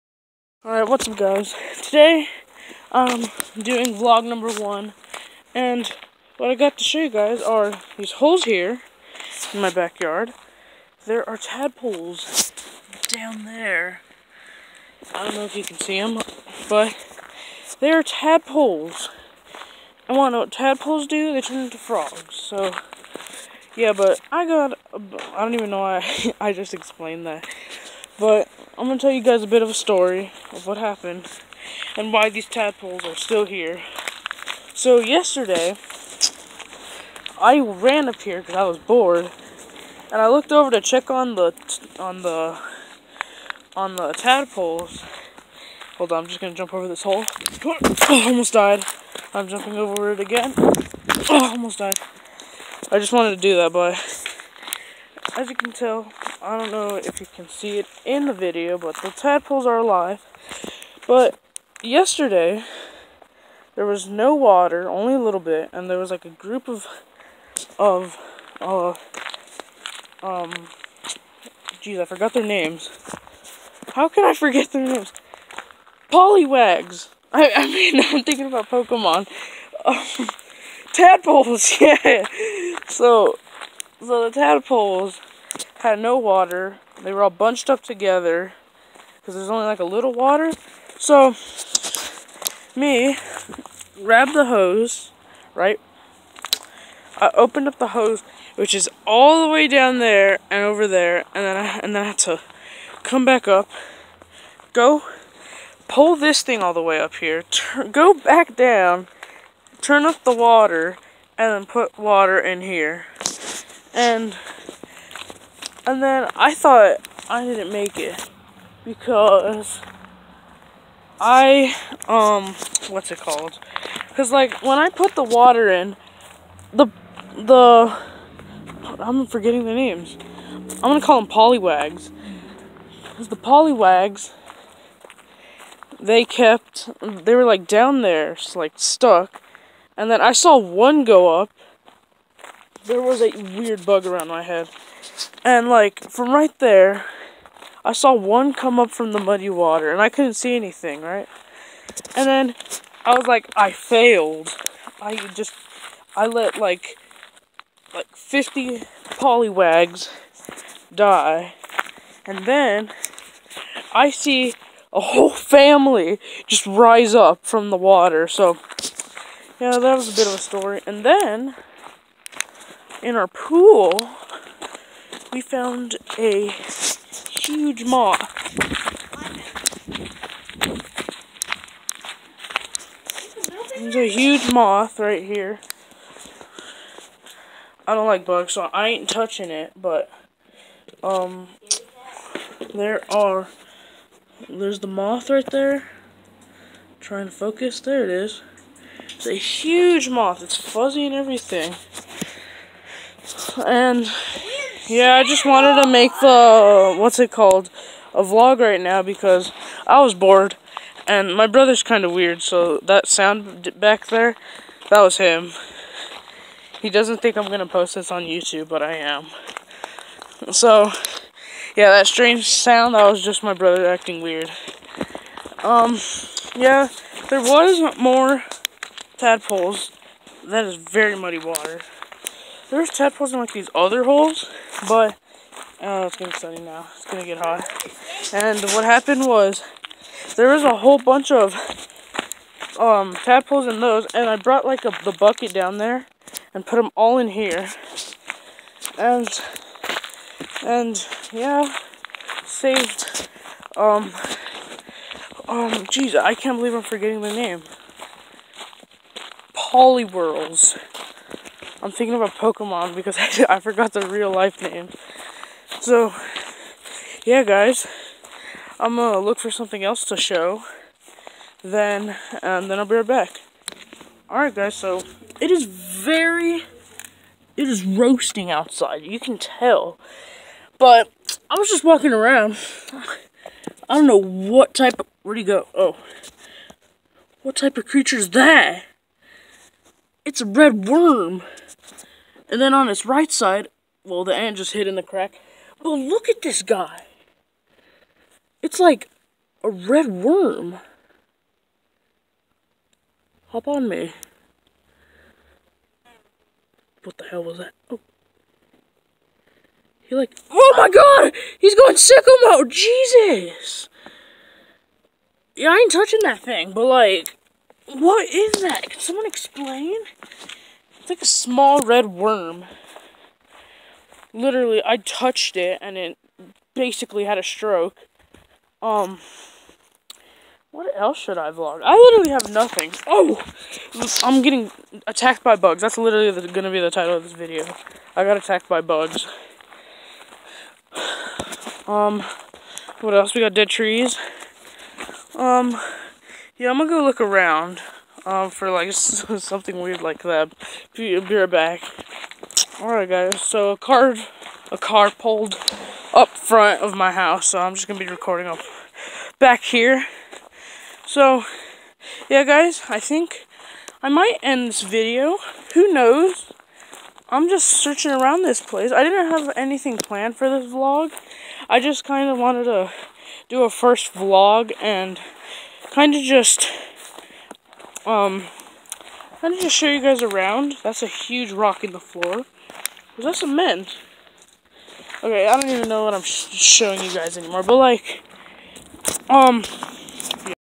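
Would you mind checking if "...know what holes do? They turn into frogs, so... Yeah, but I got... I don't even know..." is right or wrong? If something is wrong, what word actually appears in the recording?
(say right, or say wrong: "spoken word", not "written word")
wrong: "tadpoles", not "holes".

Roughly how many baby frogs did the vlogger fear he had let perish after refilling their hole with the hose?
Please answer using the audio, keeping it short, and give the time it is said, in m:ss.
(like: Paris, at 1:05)
50, at 2:38.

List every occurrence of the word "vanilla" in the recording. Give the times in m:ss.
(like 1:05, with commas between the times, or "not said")
not said.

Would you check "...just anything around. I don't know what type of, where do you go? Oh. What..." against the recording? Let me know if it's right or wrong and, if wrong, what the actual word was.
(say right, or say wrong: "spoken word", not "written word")
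wrong: "walking", not "anything".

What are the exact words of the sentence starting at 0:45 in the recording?
Hold on, I'm just gonna jump over this hole.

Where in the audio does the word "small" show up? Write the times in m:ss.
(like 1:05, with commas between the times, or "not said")
5:21.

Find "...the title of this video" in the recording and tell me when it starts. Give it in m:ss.
5:36.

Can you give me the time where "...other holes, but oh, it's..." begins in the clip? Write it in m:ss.
3:53.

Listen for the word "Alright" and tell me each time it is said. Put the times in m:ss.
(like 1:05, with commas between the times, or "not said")
0:00, 5:52.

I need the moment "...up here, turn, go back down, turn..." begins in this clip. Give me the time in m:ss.
1:47.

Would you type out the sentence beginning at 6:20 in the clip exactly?
That's a huge rock in the floor.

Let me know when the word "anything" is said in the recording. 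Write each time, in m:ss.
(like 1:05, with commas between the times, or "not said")
2:30, 6:09.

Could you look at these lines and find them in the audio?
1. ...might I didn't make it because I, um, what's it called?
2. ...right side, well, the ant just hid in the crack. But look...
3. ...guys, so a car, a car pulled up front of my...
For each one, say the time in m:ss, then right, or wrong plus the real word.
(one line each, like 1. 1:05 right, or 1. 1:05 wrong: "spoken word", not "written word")
1. 1:56 wrong: "thought", not "might"
2. 4:53 right
3. 5:53 right.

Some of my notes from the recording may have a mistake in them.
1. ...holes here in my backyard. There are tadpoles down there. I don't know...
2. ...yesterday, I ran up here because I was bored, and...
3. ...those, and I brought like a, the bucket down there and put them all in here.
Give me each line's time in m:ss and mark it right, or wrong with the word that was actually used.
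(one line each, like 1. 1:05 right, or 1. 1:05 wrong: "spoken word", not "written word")
1. 0:08 right
2. 0:34 right
3. 4:03 right.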